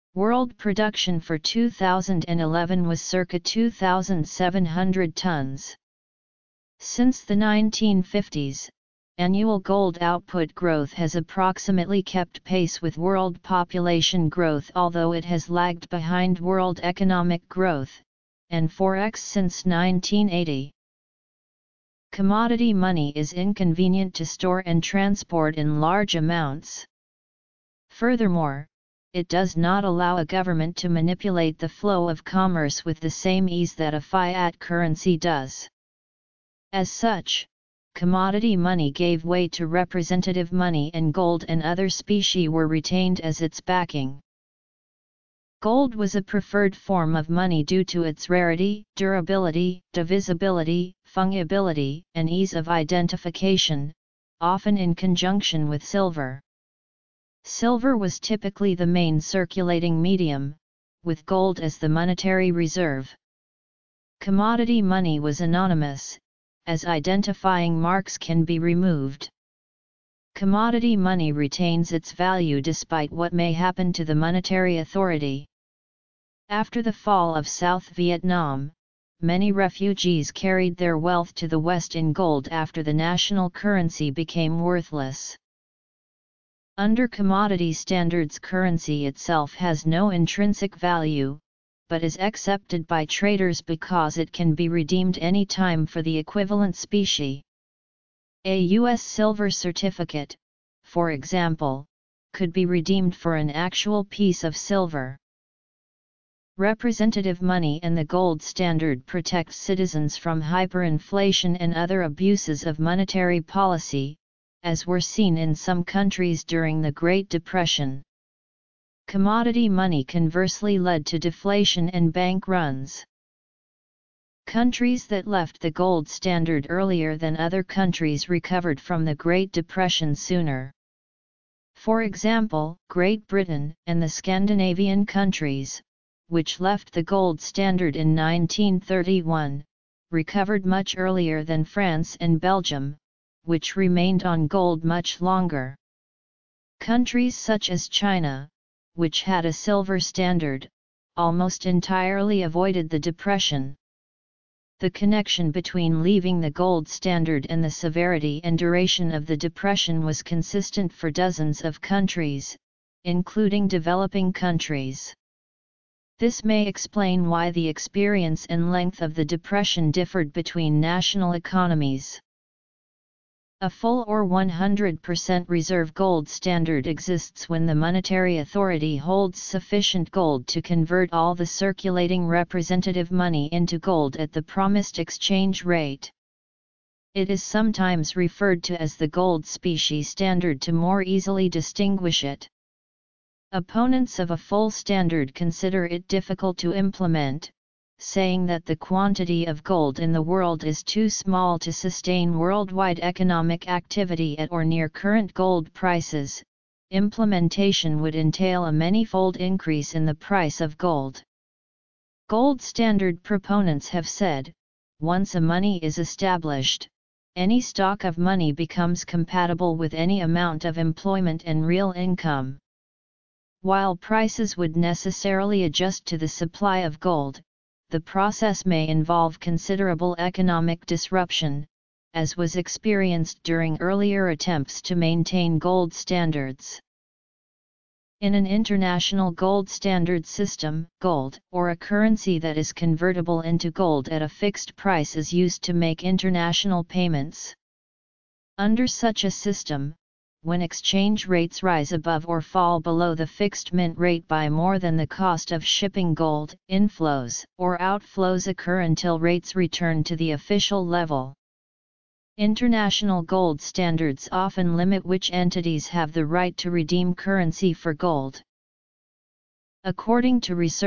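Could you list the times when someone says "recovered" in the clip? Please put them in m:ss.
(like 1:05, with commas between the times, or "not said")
2:08, 2:20.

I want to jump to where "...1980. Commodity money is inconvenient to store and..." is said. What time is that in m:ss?
0:19.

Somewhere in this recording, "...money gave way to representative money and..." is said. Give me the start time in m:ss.
0:38.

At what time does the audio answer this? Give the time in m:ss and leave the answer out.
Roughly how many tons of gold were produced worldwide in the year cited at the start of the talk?
0:03.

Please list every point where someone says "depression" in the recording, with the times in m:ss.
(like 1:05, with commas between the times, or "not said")
1:57, 2:09, 2:32, 2:39, 2:49.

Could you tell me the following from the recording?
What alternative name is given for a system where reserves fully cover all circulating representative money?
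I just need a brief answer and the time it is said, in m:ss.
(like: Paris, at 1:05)
gold specie standard, at 3:09.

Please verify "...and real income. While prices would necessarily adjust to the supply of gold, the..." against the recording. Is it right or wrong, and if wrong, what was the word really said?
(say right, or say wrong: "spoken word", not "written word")
right.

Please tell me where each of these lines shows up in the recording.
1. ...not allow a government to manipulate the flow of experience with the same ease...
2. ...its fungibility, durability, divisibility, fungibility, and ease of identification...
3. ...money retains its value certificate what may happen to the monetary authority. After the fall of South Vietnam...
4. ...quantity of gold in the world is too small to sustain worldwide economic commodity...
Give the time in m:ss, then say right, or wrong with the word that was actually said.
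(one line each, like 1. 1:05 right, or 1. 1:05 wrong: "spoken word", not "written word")
1. 0:29 wrong: "commerce", not "experience"
2. 0:48 wrong: "rarity", not "fungibility"
3. 1:10 wrong: "despite", not "certificate"
4. 3:18 wrong: "activity", not "commodity".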